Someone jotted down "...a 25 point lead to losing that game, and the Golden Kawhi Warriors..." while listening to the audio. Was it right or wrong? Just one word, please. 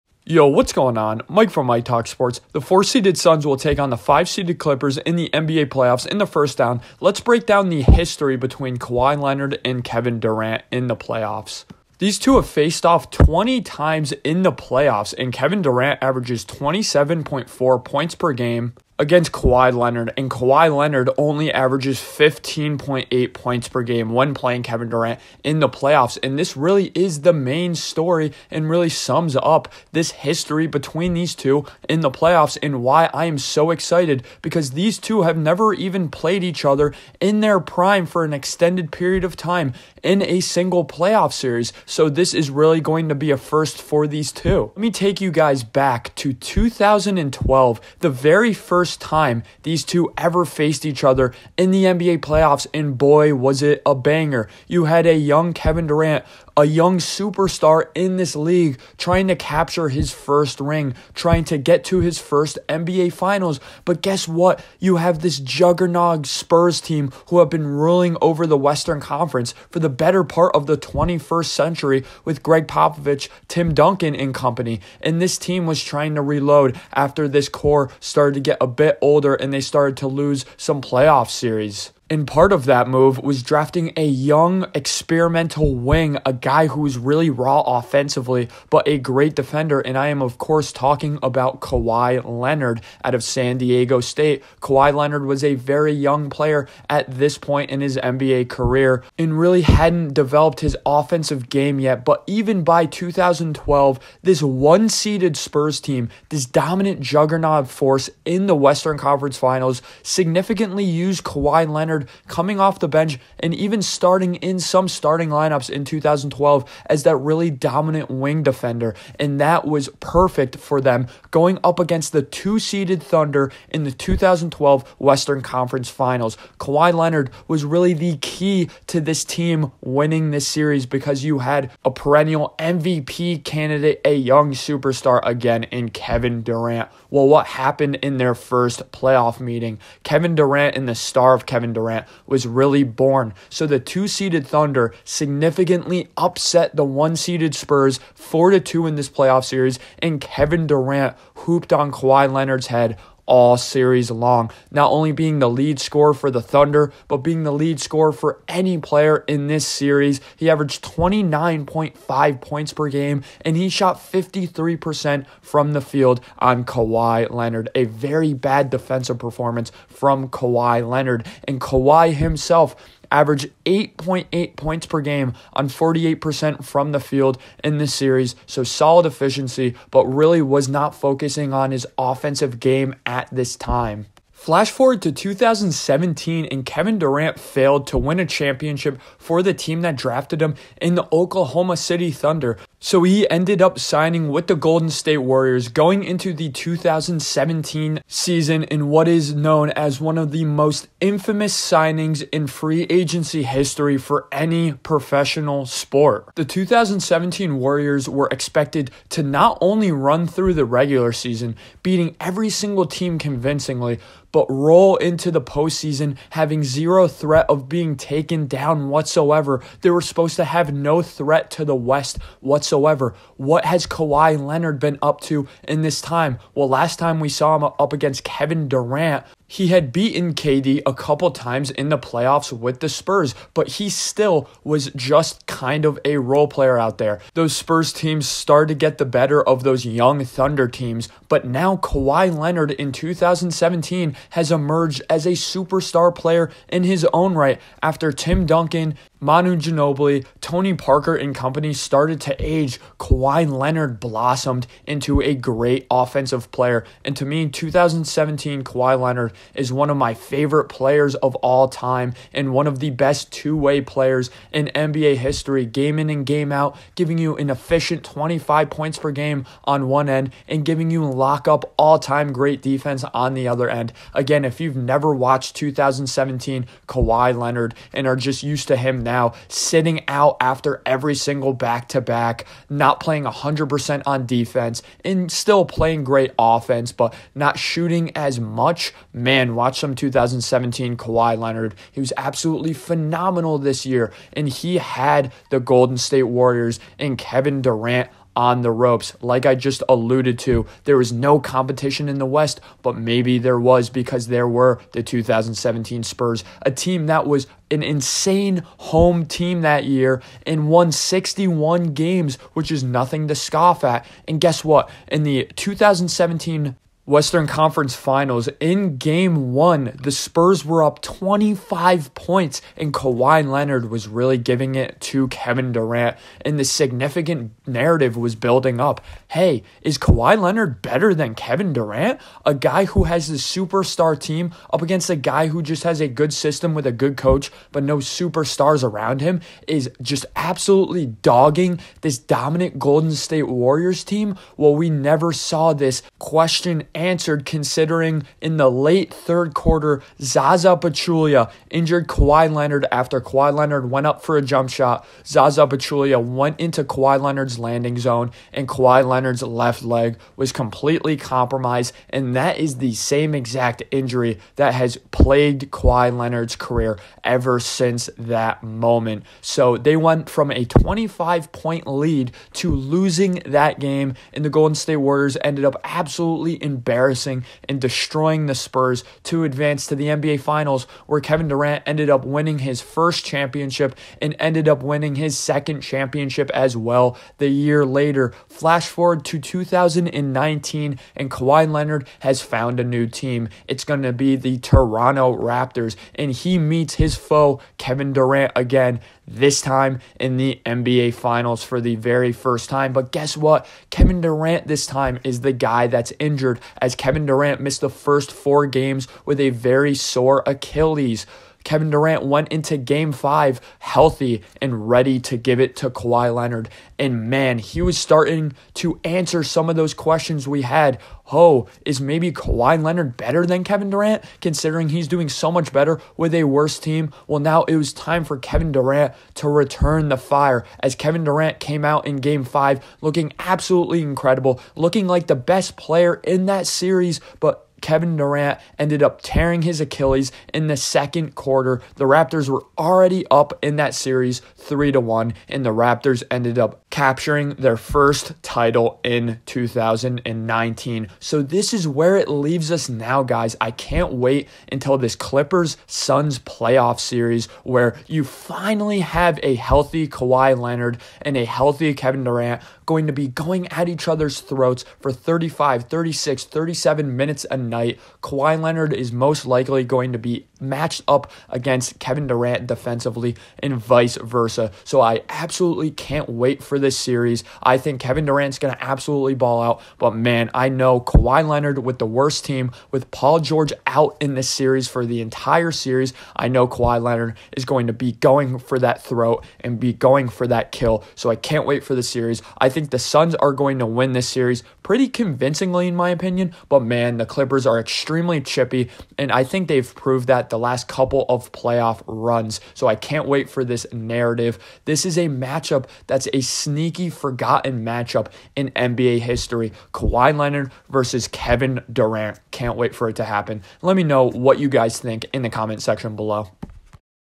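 wrong.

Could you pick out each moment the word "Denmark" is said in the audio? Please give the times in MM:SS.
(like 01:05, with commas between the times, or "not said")
not said.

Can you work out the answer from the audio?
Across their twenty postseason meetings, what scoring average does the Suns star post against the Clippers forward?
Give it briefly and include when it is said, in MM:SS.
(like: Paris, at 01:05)
27.4 points per game, at 00:16.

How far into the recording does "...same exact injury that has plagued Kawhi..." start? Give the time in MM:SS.
06:02.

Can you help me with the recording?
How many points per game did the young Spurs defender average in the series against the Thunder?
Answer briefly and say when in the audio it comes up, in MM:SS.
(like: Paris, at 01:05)
8.8, at 02:53.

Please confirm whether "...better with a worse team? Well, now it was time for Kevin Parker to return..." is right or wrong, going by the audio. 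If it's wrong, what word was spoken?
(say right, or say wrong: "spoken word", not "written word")
wrong: "Durant", not "Parker".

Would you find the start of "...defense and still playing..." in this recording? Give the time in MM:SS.
04:44.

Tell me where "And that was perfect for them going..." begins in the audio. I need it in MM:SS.
01:59.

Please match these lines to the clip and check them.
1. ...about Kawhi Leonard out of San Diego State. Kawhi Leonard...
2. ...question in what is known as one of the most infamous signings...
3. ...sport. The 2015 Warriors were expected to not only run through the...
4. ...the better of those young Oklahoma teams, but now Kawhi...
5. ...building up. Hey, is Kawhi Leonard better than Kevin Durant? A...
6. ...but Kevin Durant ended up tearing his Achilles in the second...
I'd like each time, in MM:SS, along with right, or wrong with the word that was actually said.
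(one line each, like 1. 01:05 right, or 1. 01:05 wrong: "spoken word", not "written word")
1. 01:31 right
2. 03:18 wrong: "season", not "question"
3. 03:25 wrong: "2017", not "2015"
4. 03:58 wrong: "Thunder", not "Oklahoma"
5. 05:28 right
6. 07:17 right.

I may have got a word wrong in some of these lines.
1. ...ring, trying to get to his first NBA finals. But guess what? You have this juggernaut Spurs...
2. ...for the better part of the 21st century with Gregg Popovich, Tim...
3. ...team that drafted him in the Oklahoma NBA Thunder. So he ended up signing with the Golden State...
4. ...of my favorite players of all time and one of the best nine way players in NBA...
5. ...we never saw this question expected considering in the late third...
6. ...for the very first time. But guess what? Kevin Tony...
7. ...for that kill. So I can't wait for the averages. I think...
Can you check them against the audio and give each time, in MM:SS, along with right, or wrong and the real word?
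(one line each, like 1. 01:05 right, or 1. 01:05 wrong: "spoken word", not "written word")
1. 01:00 right
2. 01:09 right
3. 03:09 wrong: "City", not "NBA"
4. 04:19 wrong: "two", not "nine"
5. 05:44 wrong: "answered", not "expected"
6. 06:41 wrong: "Durant", not "Tony"
7. 08:10 wrong: "series", not "averages".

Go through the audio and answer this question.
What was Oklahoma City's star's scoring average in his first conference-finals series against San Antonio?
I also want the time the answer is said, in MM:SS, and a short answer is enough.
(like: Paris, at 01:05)
29.5 points per game, at 02:40.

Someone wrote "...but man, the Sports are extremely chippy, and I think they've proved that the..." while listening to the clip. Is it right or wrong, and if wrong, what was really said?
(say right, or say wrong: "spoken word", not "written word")
wrong: "Clippers", not "Sports".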